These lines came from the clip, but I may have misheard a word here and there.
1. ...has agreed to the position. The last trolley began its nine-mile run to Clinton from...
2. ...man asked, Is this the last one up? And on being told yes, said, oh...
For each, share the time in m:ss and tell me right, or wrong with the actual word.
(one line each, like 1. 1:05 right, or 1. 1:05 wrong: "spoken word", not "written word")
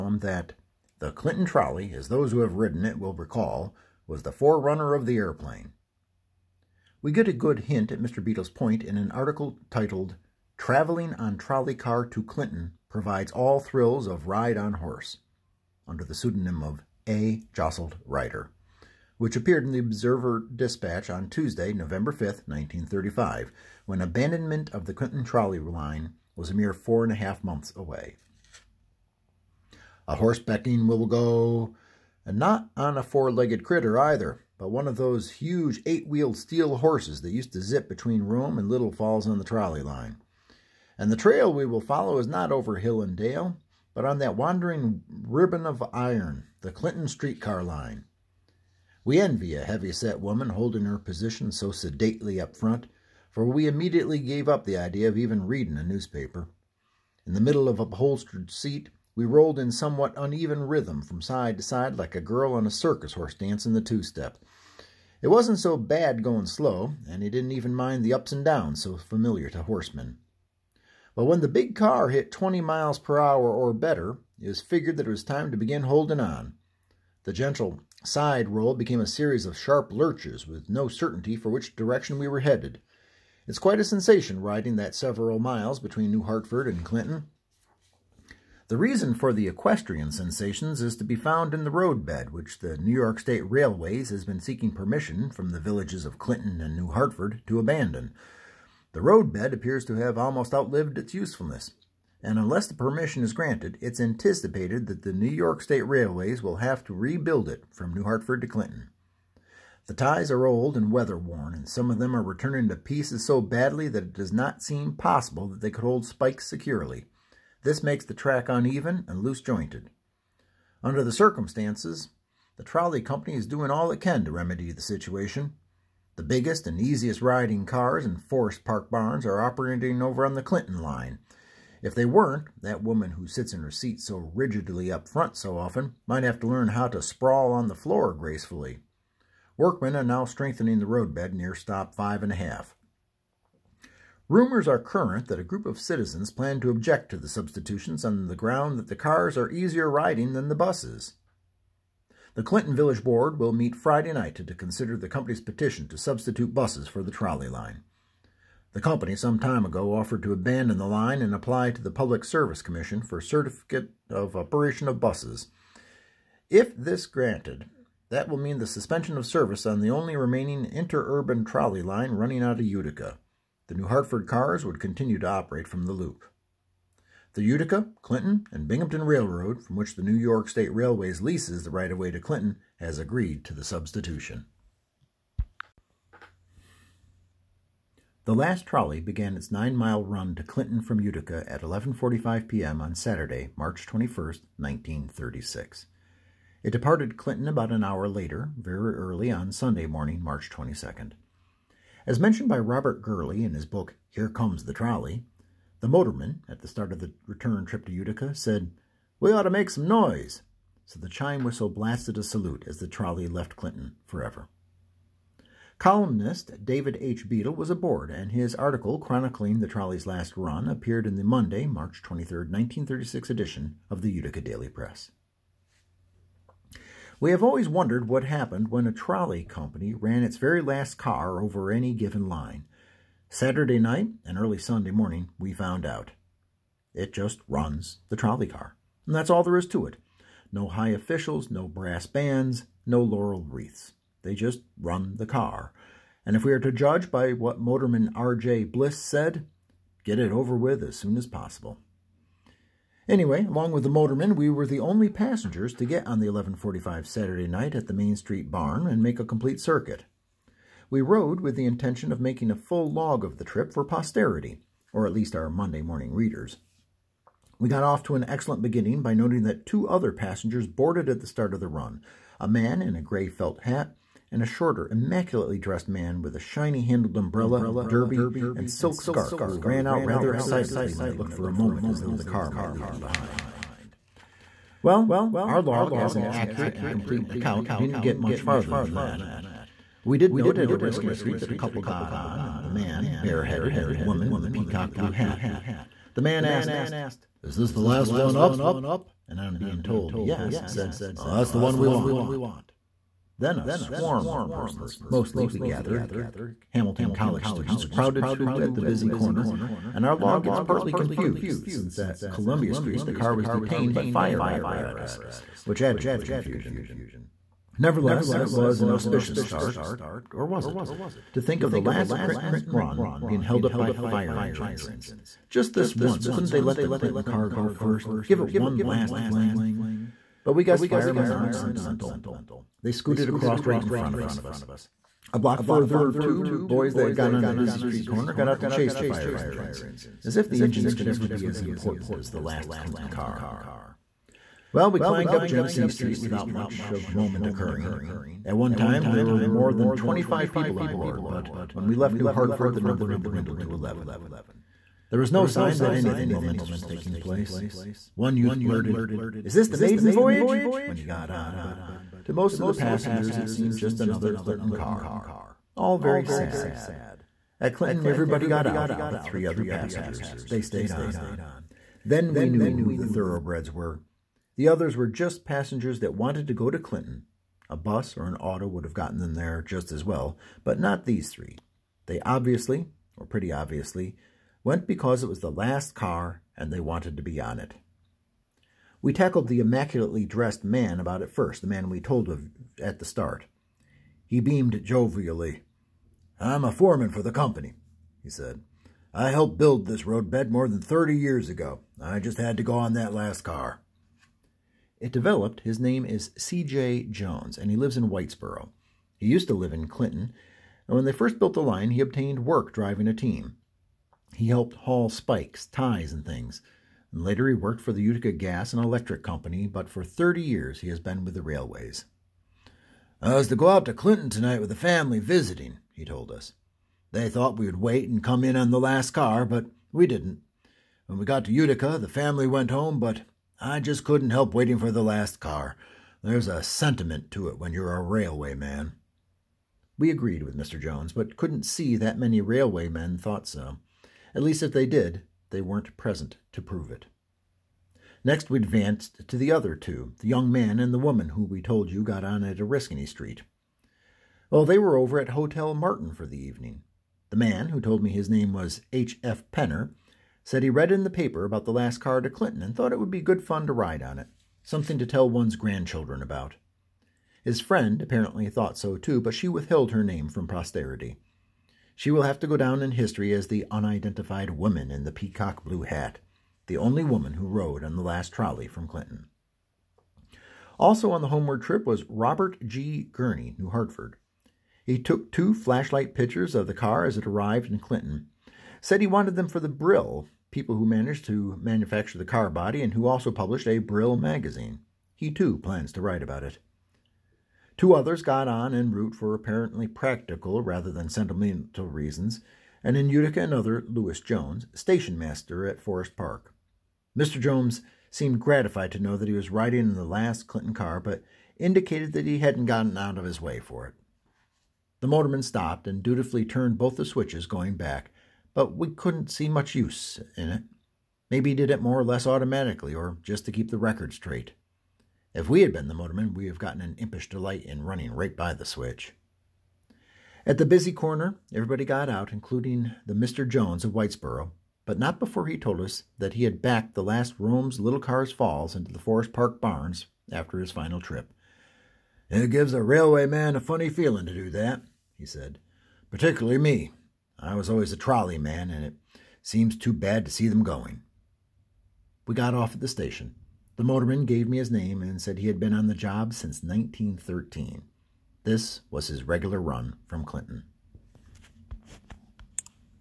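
1. 3:02 wrong: "substitution", not "position"
2. 4:56 right.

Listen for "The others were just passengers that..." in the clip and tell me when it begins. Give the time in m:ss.
6:14.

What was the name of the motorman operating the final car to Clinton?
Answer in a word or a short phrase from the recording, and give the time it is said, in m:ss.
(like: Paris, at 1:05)
R.J. Bliss, at 4:08.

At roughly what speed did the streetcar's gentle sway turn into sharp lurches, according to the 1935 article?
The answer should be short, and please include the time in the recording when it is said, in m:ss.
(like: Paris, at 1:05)
20 miles per hour, at 1:12.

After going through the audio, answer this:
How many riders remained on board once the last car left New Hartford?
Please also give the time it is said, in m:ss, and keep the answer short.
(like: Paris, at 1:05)
11, at 5:53.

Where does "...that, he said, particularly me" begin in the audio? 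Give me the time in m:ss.
9:04.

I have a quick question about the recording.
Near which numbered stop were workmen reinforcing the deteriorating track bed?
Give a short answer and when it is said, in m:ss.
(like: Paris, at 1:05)
stop 5 and a half, at 2:21.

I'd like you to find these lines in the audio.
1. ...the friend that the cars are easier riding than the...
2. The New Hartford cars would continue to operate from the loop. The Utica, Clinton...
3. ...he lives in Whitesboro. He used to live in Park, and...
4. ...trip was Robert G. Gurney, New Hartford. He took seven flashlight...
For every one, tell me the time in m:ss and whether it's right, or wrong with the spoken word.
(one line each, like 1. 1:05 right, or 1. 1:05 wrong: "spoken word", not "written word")
1. 2:28 wrong: "ground", not "friend"
2. 2:53 right
3. 6:47 wrong: "Clinton", not "Park"
4. 8:01 wrong: "two", not "seven".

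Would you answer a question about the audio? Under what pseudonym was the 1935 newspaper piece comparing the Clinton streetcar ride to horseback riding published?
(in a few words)
A. Jostled Rider.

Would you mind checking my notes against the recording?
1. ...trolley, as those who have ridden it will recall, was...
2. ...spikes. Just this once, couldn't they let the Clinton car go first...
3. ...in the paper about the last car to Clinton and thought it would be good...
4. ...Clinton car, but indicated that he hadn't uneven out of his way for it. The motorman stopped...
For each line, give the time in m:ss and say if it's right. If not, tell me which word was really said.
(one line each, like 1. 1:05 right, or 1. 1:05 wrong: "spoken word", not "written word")
1. 0:01 right
2. 5:24 wrong: "engines", not "spikes"
3. 7:40 right
4. 8:30 wrong: "gotten", not "uneven".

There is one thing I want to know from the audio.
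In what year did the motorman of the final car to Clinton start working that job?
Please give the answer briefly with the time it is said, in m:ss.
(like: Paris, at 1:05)
1913, at 9:16.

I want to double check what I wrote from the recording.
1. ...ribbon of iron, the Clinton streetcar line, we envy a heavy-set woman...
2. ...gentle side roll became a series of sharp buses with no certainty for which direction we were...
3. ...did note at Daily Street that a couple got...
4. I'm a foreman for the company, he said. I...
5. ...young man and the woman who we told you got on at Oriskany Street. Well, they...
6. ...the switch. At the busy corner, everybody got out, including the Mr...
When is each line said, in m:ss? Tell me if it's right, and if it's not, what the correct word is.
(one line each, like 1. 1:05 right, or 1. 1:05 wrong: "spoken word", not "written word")
1. 0:45 right
2. 1:17 wrong: "lurches", not "buses"
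3. 4:50 wrong: "Oriskany", not "Daily"
4. 6:36 right
5. 7:30 right
6. 8:48 right.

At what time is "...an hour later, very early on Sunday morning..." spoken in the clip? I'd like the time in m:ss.
3:17.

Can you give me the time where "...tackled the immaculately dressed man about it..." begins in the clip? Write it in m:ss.
6:29.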